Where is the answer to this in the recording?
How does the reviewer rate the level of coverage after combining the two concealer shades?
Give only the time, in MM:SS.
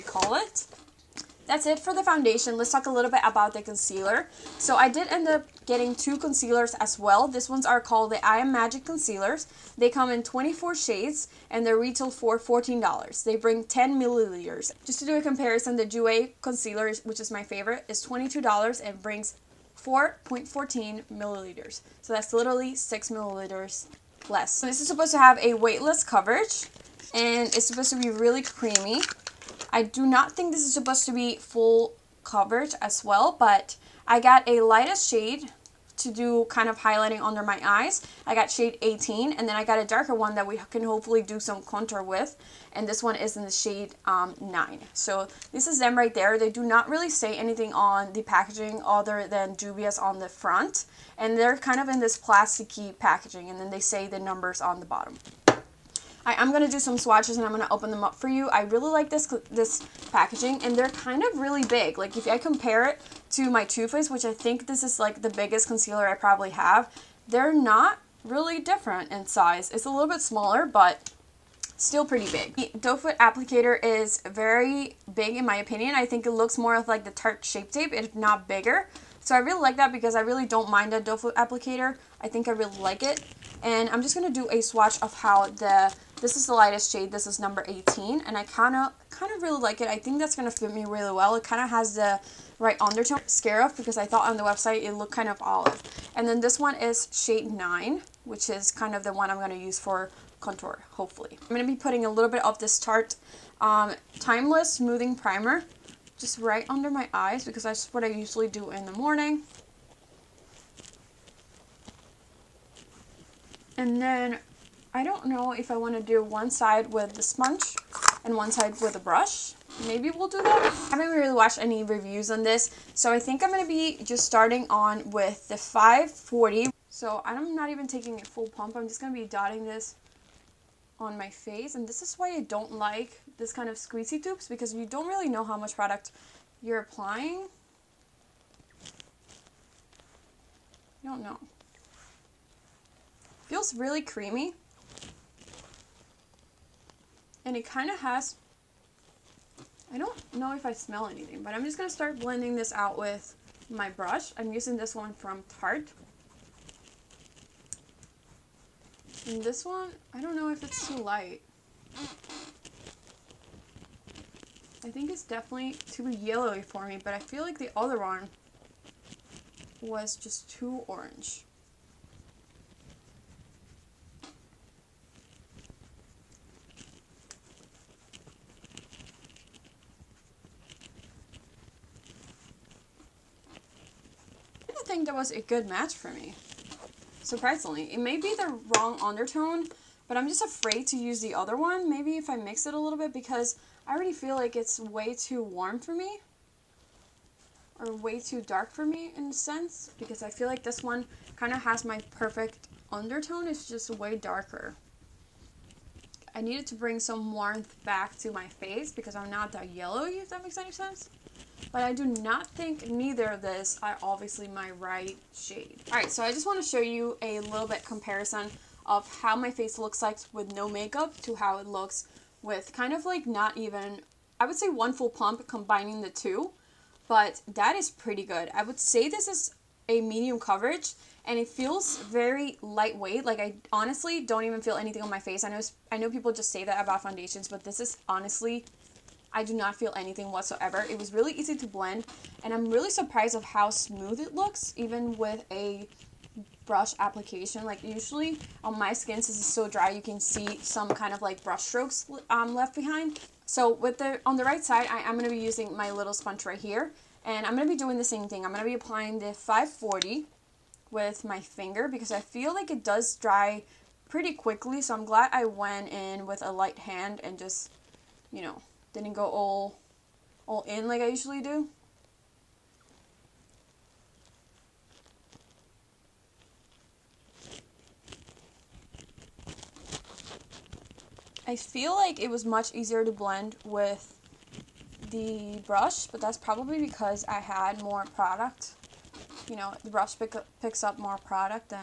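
03:50.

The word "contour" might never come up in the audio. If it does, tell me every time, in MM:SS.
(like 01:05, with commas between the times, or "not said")
00:41, 01:40.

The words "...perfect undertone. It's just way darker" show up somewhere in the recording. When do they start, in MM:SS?
03:22.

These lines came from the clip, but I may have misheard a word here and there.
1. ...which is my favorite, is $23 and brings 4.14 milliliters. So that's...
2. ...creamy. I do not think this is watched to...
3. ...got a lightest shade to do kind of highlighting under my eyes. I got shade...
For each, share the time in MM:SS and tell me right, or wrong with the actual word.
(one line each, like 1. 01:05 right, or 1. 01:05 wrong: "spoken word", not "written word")
1. 00:17 wrong: "22", not "23"
2. 00:28 wrong: "supposed", not "watched"
3. 00:34 right.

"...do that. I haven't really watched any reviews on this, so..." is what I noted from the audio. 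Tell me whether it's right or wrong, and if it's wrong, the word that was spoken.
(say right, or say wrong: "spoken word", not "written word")
right.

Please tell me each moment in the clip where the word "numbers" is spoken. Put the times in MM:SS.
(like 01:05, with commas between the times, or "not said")
00:54, 01:27.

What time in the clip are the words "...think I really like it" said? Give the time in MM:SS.
01:22.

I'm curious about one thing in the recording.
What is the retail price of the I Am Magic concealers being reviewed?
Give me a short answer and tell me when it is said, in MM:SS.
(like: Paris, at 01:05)
$14, at 00:12.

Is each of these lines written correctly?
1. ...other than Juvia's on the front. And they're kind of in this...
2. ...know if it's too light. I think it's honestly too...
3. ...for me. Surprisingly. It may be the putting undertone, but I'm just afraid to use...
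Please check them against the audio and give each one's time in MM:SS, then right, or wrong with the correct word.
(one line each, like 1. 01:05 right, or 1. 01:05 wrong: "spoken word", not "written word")
1. 00:48 right
2. 02:40 wrong: "definitely", not "honestly"
3. 03:05 wrong: "wrong", not "putting".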